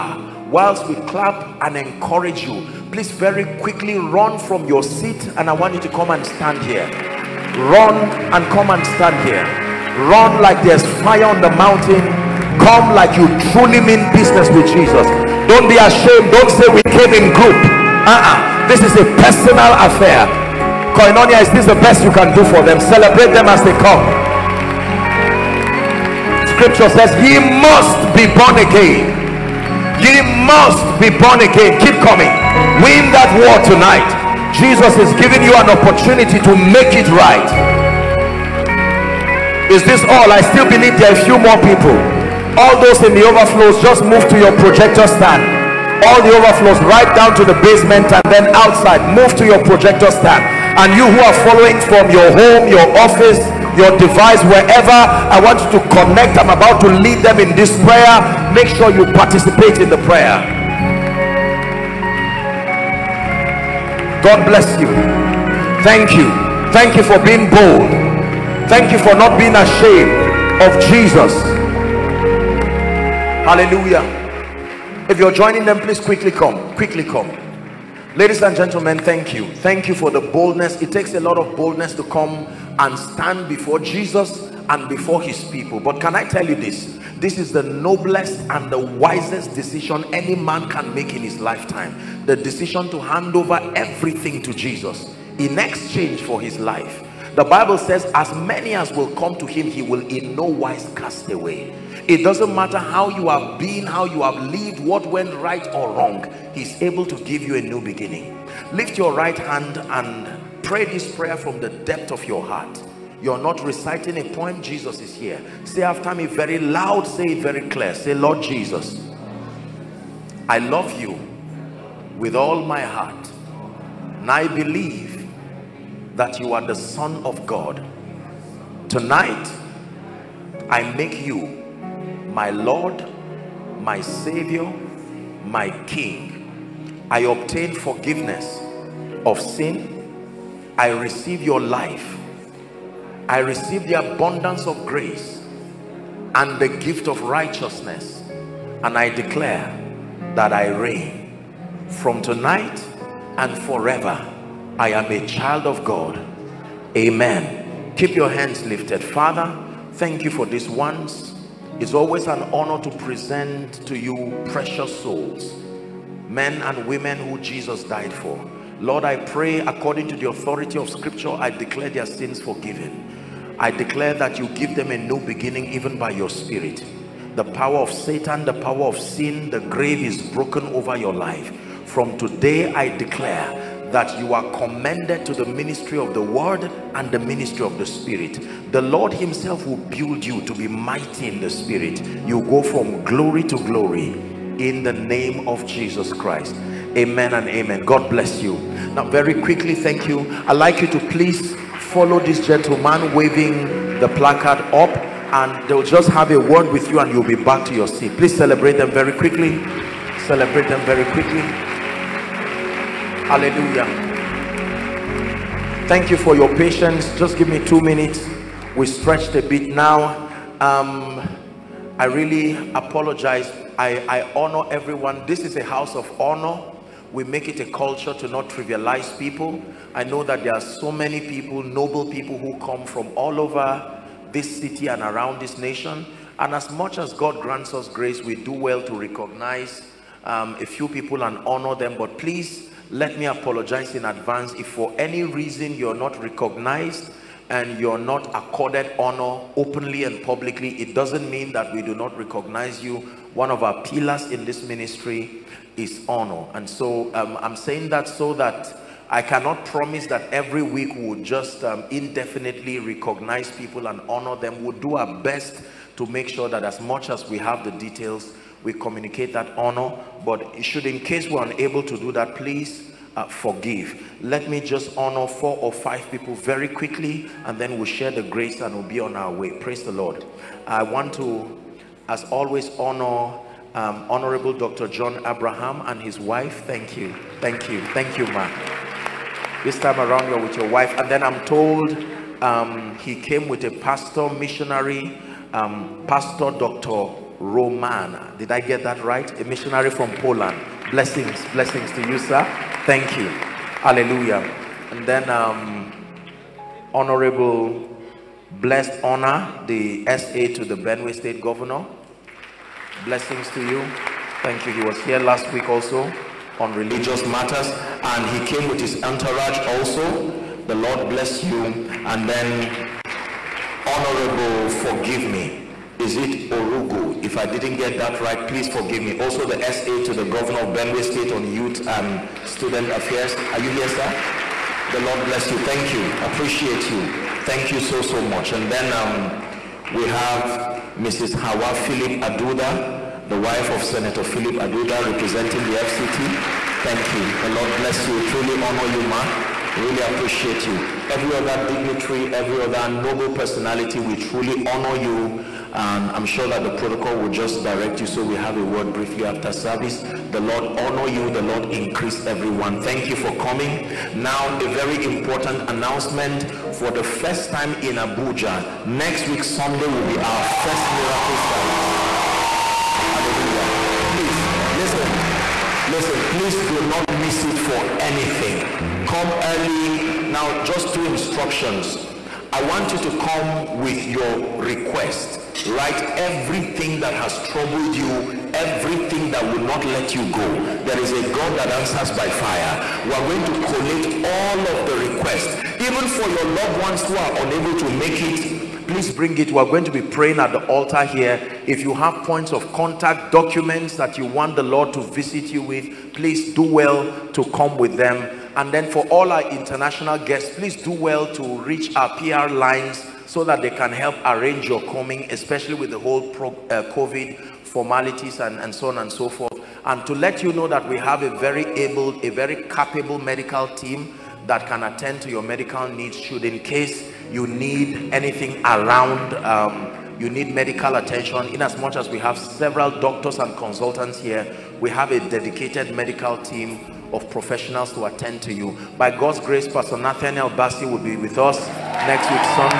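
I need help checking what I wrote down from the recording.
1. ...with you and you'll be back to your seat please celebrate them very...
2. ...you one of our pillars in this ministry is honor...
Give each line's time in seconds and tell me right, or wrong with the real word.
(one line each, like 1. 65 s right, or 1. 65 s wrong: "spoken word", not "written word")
1. 206 s right
2. 252 s right.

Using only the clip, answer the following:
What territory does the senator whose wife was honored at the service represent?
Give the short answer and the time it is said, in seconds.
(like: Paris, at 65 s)
FCT, at 345 s.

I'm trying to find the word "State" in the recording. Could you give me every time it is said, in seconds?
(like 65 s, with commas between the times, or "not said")
311 s, 331 s.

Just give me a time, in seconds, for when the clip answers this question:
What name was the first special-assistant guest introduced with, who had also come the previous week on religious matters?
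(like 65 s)
308 s.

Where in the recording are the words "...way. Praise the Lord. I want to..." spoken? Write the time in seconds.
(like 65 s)
279 s.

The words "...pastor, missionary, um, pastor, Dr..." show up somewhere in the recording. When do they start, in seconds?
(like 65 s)
293 s.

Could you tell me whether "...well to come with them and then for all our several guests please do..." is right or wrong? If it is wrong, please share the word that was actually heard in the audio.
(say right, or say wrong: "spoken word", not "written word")
wrong: "international", not "several".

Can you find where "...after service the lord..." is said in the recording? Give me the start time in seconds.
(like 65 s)
359 s.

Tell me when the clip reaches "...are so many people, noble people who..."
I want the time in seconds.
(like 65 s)
230 s.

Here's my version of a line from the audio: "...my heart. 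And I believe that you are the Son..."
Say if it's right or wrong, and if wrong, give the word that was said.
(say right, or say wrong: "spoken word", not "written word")
right.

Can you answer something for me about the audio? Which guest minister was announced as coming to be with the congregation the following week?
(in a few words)
Pastor Nathaniel Bassey.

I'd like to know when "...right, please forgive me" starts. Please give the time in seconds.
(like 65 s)
328 s.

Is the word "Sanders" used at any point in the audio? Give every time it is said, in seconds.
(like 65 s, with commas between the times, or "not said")
not said.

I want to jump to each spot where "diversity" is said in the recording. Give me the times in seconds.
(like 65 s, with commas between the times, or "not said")
not said.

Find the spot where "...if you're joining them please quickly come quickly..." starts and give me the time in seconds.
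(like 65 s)
75 s.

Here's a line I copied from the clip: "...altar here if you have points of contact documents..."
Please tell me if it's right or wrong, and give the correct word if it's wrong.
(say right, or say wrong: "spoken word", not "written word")
right.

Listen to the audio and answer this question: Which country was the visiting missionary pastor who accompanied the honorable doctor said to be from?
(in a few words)
Poland.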